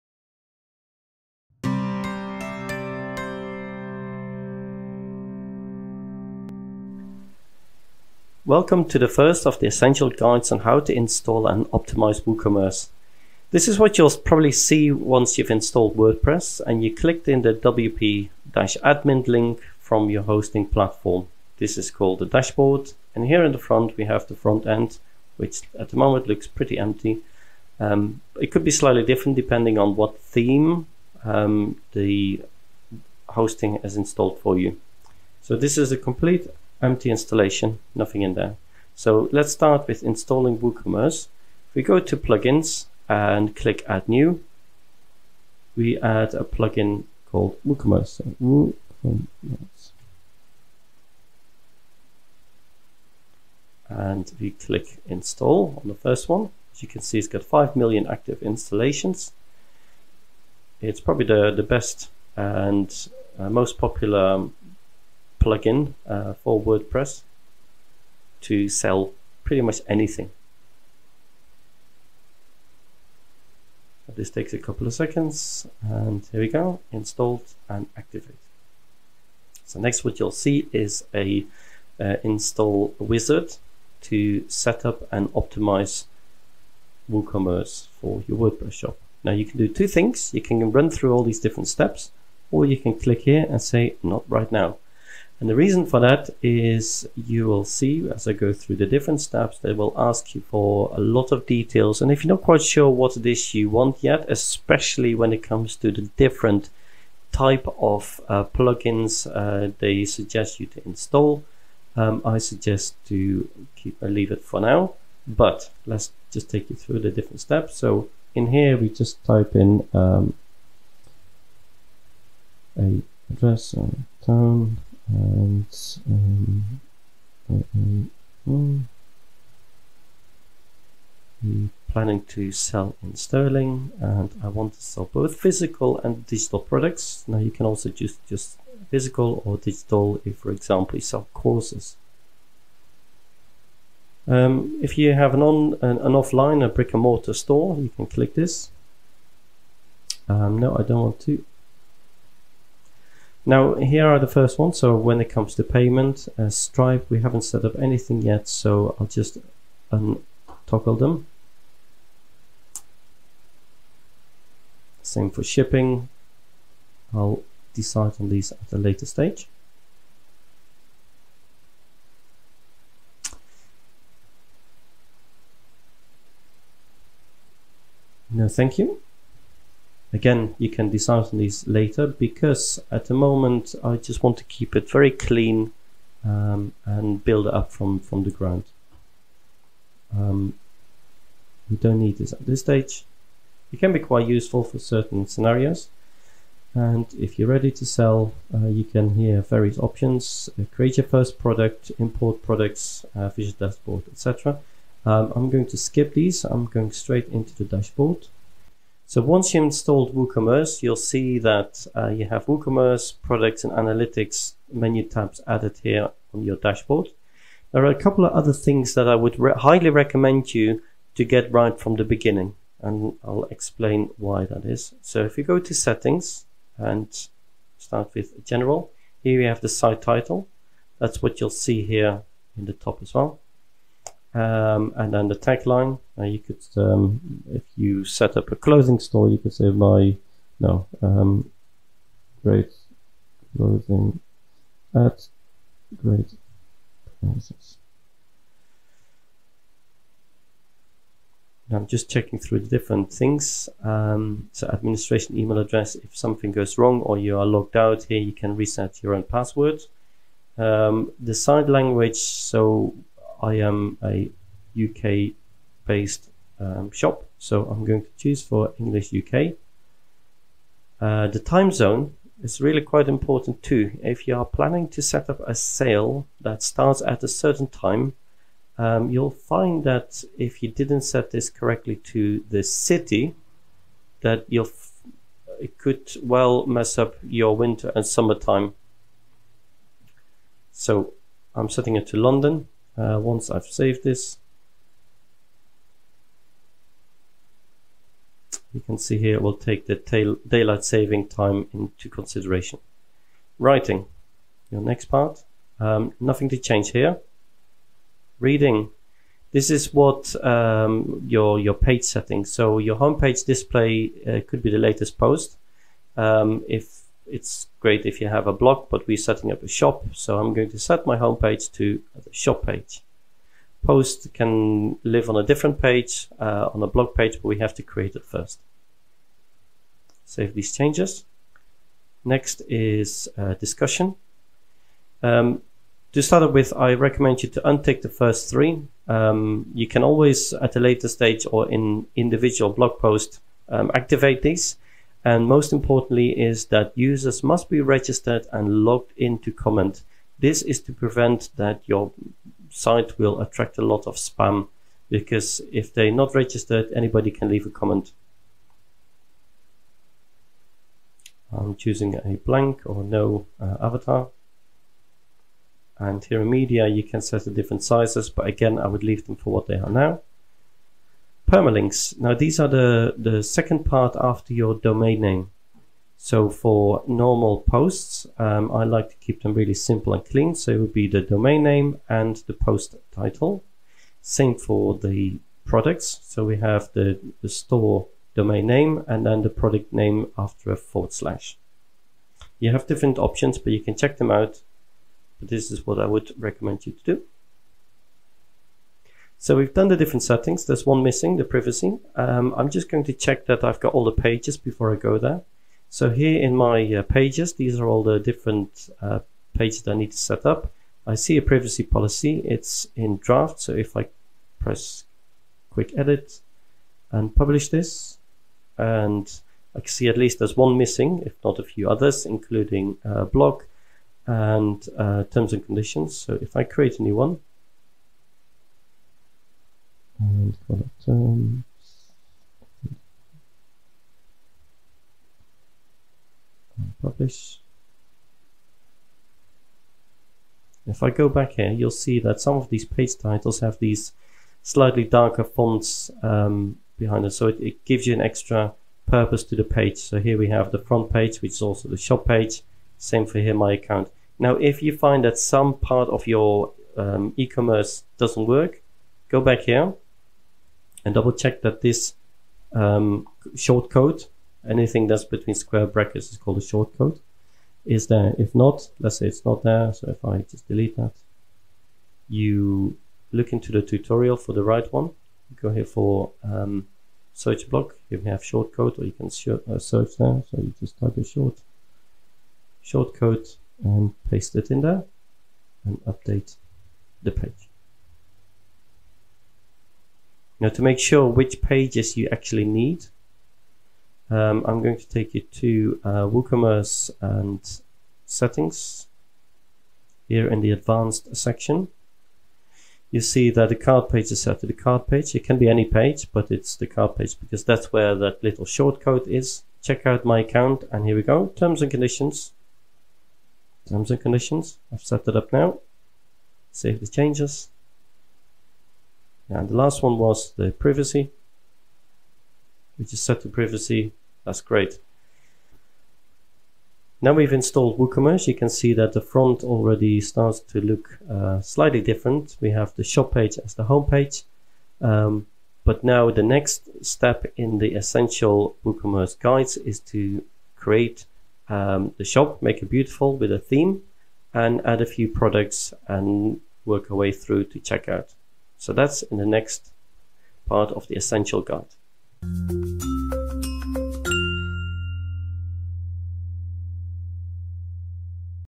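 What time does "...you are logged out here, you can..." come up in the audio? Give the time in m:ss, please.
4:17.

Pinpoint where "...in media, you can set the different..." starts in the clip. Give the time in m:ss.
6:06.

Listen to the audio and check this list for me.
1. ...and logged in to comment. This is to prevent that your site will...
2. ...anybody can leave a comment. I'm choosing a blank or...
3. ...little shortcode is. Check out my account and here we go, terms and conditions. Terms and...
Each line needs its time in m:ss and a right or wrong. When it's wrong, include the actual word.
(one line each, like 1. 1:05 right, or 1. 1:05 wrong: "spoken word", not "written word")
1. 5:48 right
2. 5:56 right
3. 8:28 right.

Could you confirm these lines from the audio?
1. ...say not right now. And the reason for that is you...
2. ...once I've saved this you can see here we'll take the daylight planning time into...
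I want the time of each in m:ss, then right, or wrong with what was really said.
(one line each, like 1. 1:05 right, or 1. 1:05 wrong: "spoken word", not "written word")
1. 1:33 right
2. 4:53 wrong: "saving", not "planning".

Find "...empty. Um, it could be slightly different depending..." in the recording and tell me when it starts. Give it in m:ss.
0:26.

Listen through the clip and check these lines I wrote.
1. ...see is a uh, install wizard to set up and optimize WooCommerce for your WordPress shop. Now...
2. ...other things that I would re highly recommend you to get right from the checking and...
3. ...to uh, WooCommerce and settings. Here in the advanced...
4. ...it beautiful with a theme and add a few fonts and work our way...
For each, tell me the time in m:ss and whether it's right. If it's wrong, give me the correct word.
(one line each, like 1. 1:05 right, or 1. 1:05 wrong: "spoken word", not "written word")
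1. 1:20 right
2. 3:38 wrong: "beginning", not "checking"
3. 8:15 right
4. 9:02 wrong: "products", not "fonts".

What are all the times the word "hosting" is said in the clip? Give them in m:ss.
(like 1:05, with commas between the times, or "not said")
0:20, 0:33.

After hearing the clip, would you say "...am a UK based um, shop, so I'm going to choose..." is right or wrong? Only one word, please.
right.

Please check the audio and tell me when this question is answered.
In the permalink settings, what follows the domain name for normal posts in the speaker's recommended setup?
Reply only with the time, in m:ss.
6:22.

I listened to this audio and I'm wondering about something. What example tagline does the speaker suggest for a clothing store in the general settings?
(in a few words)
Great clothing at great prices.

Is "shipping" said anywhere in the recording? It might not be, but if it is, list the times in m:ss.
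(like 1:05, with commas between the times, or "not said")
2:45.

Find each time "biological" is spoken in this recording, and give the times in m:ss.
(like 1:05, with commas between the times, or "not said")
not said.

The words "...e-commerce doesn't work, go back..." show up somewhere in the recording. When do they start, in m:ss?
7:37.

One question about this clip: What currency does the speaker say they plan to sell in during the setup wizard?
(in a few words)
Sterling.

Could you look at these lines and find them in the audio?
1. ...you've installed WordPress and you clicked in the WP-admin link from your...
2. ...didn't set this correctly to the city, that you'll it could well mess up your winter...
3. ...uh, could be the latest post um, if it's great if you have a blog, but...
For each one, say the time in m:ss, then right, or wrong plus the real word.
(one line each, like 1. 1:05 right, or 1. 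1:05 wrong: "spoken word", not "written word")
1. 0:15 right
2. 4:40 right
3. 5:14 right.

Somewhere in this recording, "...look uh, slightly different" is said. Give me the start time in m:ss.
8:50.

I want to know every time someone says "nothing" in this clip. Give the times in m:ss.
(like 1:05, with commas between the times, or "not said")
0:37, 5:06.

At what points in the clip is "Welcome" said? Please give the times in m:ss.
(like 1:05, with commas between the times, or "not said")
0:08.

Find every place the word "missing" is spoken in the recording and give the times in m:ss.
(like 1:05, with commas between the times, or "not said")
6:41, 7:00.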